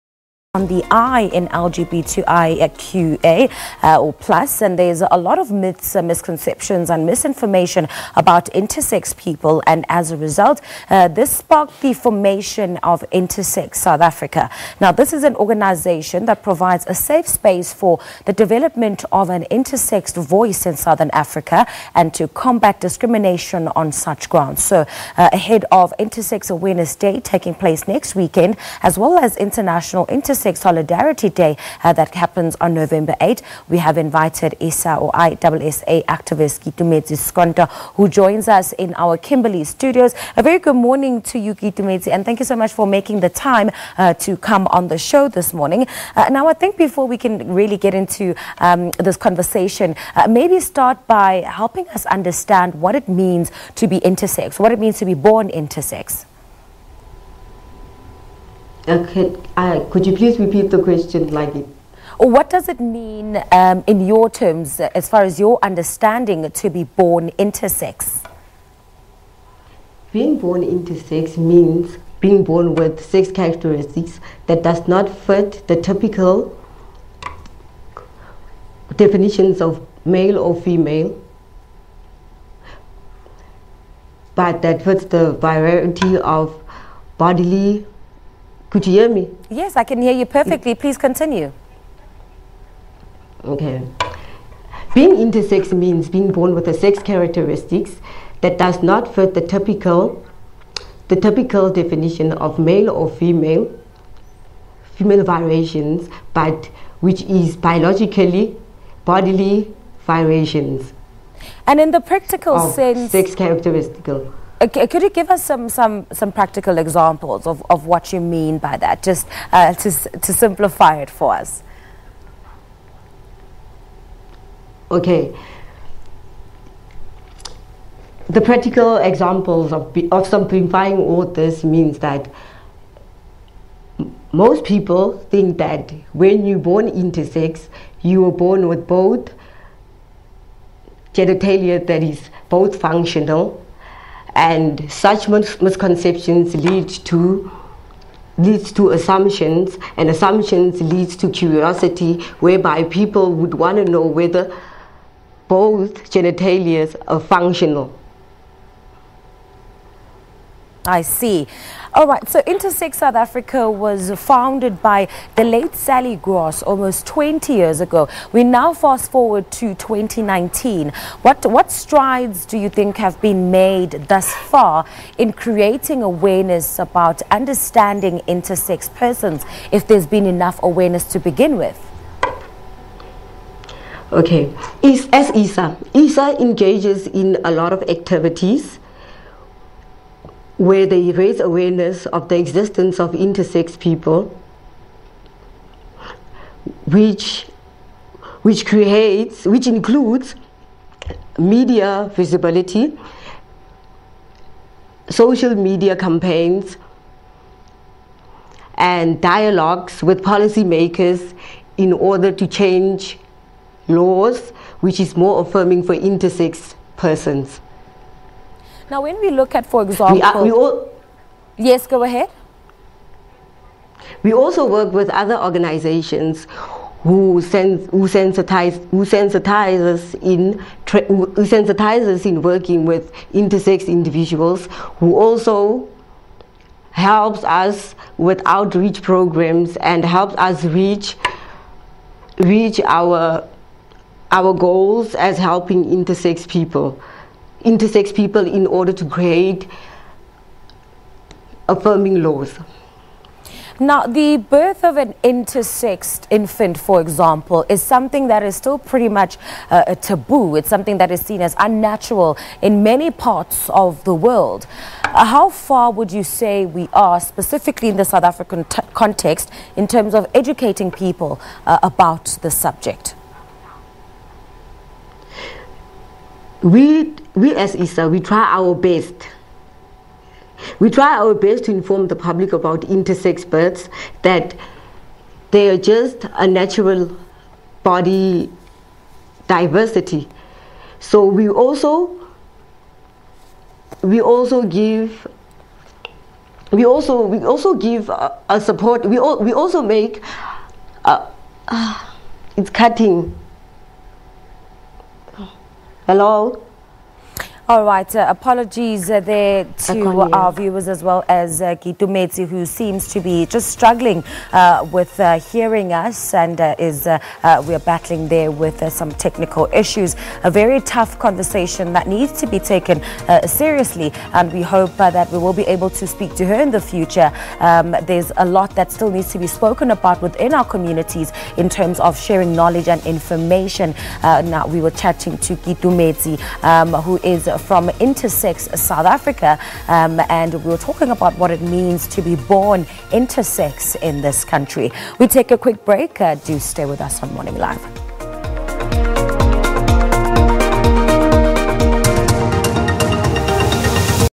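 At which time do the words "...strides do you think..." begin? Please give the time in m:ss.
2:51.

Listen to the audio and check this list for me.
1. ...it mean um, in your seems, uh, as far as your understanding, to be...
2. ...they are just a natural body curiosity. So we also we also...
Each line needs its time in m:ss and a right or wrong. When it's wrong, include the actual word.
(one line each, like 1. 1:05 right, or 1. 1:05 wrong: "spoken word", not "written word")
1. 1:02 wrong: "terms", not "seems"
2. 4:45 wrong: "diversity", not "curiosity".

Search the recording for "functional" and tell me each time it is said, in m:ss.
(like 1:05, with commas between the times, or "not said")
2:22, 2:37.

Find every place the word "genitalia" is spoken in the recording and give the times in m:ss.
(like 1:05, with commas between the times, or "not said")
2:21, 2:36.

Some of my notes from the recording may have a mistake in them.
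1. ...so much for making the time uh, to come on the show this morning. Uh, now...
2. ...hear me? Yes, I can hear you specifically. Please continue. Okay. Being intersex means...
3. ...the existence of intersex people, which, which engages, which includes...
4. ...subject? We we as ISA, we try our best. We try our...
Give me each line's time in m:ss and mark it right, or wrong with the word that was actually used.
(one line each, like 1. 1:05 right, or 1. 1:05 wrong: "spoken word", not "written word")
1. 0:42 right
2. 1:28 wrong: "perfectly", not "specifically"
3. 3:12 wrong: "creates", not "engages"
4. 4:32 right.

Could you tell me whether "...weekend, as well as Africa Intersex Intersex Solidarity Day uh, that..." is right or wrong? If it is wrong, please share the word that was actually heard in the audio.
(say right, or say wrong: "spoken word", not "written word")
wrong: "International", not "Africa".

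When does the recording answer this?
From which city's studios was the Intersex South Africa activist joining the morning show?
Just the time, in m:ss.
0:39.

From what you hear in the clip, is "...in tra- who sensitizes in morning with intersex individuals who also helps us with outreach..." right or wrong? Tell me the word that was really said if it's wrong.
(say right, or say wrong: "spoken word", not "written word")
wrong: "working", not "morning".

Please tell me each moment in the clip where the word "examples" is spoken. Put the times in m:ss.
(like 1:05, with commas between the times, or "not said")
1:56, 2:08, 3:39, 4:17.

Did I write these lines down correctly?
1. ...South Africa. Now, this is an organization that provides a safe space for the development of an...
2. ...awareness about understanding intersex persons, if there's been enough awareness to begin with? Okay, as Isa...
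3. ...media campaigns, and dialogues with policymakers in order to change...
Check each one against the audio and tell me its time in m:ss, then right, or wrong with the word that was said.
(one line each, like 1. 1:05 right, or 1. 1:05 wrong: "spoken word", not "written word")
1. 0:13 right
2. 2:56 right
3. 3:25 right.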